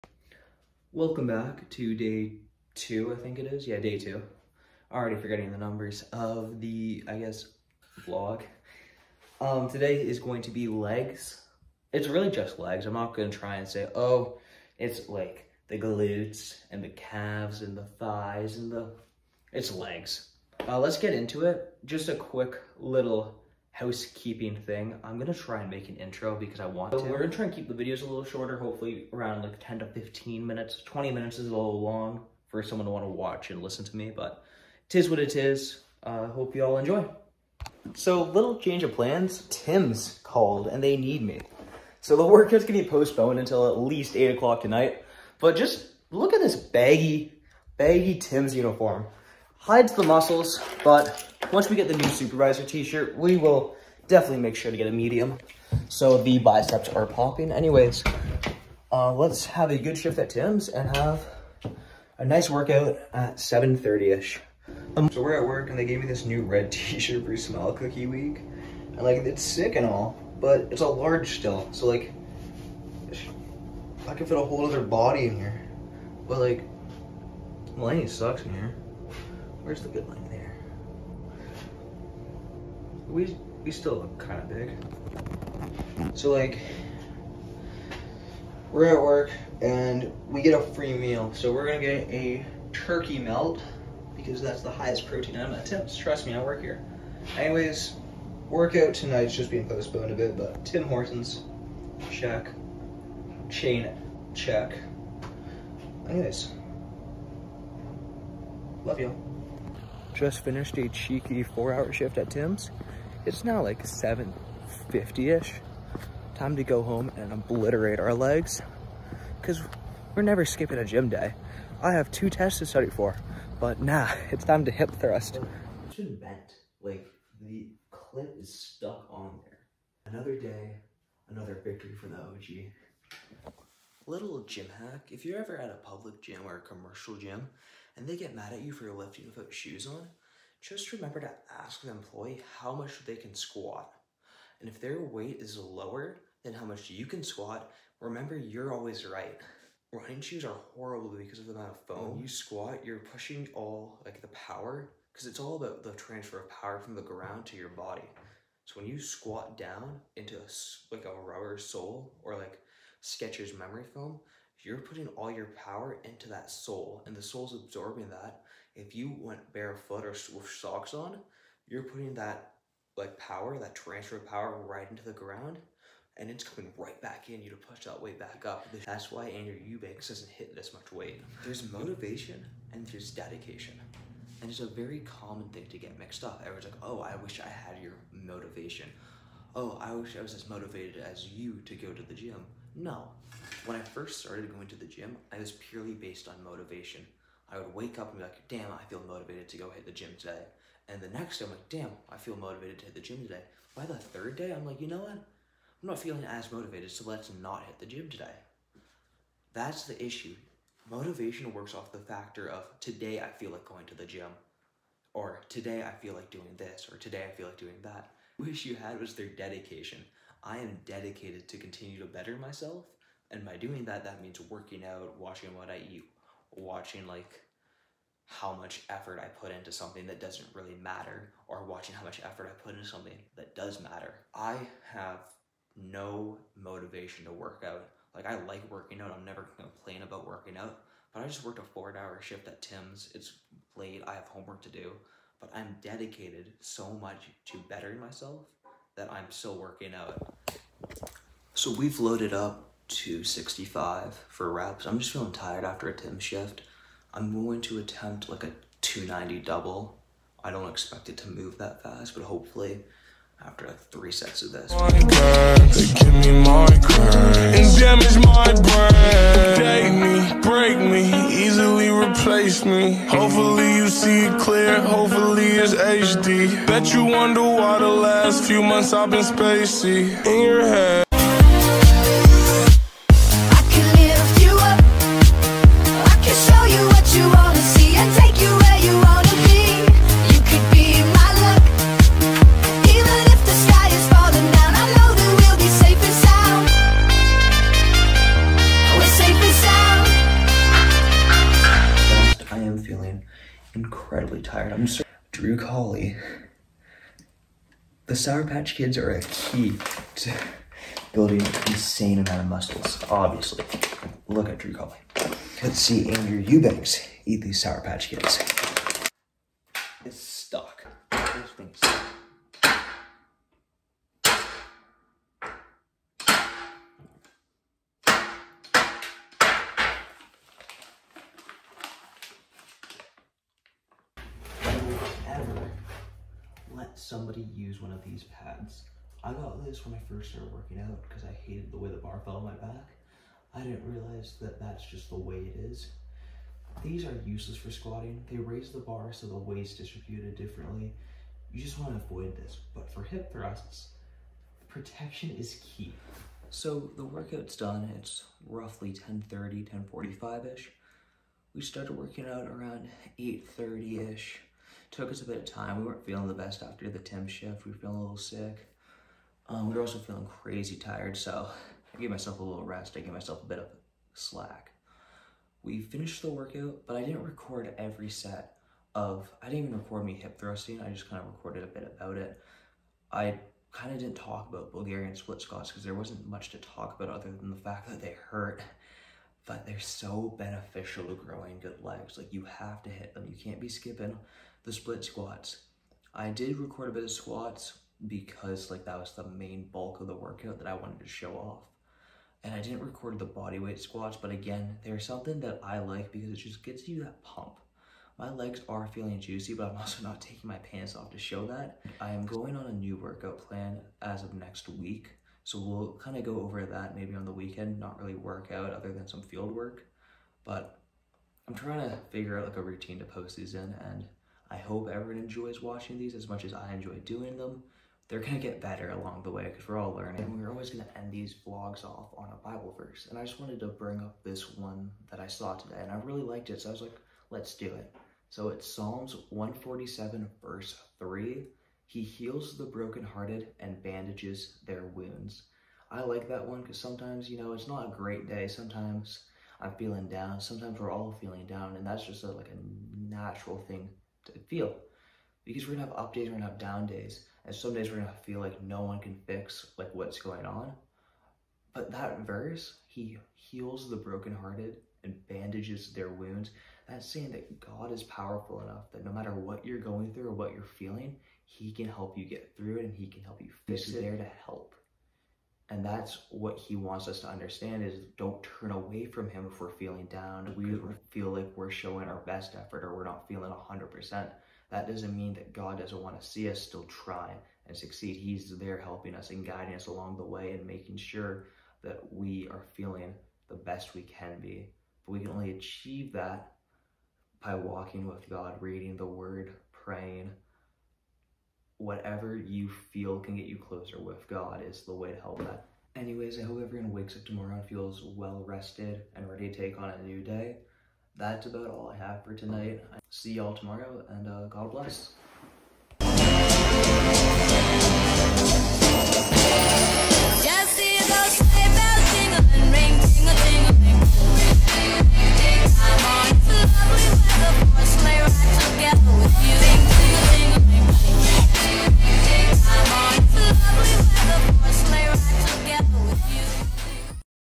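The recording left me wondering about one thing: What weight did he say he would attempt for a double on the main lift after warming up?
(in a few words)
290.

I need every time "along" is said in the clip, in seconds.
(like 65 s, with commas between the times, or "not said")
428 s, 489 s.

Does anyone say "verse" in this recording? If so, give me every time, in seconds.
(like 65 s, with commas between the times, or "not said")
432 s, 440 s, 462 s.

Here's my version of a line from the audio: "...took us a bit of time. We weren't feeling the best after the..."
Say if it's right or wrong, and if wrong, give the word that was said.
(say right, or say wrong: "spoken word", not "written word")
right.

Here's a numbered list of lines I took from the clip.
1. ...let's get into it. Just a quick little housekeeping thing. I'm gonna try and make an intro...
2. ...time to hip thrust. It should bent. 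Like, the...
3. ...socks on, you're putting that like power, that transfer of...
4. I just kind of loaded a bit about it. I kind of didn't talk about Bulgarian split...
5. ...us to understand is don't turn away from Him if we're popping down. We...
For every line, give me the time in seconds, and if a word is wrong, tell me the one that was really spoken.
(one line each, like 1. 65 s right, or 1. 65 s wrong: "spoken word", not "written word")
1. 20 s right
2. 124 s right
3. 170 s right
4. 380 s wrong: "recorded", not "loaded"
5. 477 s wrong: "feeling", not "popping".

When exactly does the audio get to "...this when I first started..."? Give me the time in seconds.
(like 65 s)
339 s.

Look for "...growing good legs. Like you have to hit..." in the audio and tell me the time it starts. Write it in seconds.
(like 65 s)
391 s.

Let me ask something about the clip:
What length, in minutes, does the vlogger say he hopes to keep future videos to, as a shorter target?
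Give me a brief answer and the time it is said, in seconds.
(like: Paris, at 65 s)
10 to 15 minutes, at 29 s.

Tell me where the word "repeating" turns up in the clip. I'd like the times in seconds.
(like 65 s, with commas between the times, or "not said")
not said.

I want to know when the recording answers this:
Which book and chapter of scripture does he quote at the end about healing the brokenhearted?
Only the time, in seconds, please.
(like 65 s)
438 s.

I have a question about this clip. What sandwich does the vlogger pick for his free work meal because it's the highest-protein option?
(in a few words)
turkey melt.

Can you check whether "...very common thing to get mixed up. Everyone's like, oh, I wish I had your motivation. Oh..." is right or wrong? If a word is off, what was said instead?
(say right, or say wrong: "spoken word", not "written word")
right.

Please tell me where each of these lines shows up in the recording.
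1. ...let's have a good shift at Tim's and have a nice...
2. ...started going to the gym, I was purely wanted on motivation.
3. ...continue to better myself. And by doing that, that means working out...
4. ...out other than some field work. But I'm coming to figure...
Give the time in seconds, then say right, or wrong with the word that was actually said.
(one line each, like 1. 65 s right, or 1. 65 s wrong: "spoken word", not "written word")
1. 59 s right
2. 194 s wrong: "based", not "wanted"
3. 221 s right
4. 418 s wrong: "trying", not "coming".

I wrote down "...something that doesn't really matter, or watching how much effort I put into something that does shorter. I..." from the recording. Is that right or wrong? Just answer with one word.
wrong.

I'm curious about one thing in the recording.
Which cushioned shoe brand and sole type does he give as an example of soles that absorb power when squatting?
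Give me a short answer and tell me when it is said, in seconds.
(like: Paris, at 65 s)
Skechers memory foam, at 163 s.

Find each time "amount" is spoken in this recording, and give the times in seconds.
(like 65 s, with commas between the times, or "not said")
151 s, 312 s.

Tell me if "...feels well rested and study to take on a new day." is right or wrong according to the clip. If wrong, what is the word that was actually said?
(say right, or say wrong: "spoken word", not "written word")
wrong: "ready", not "study".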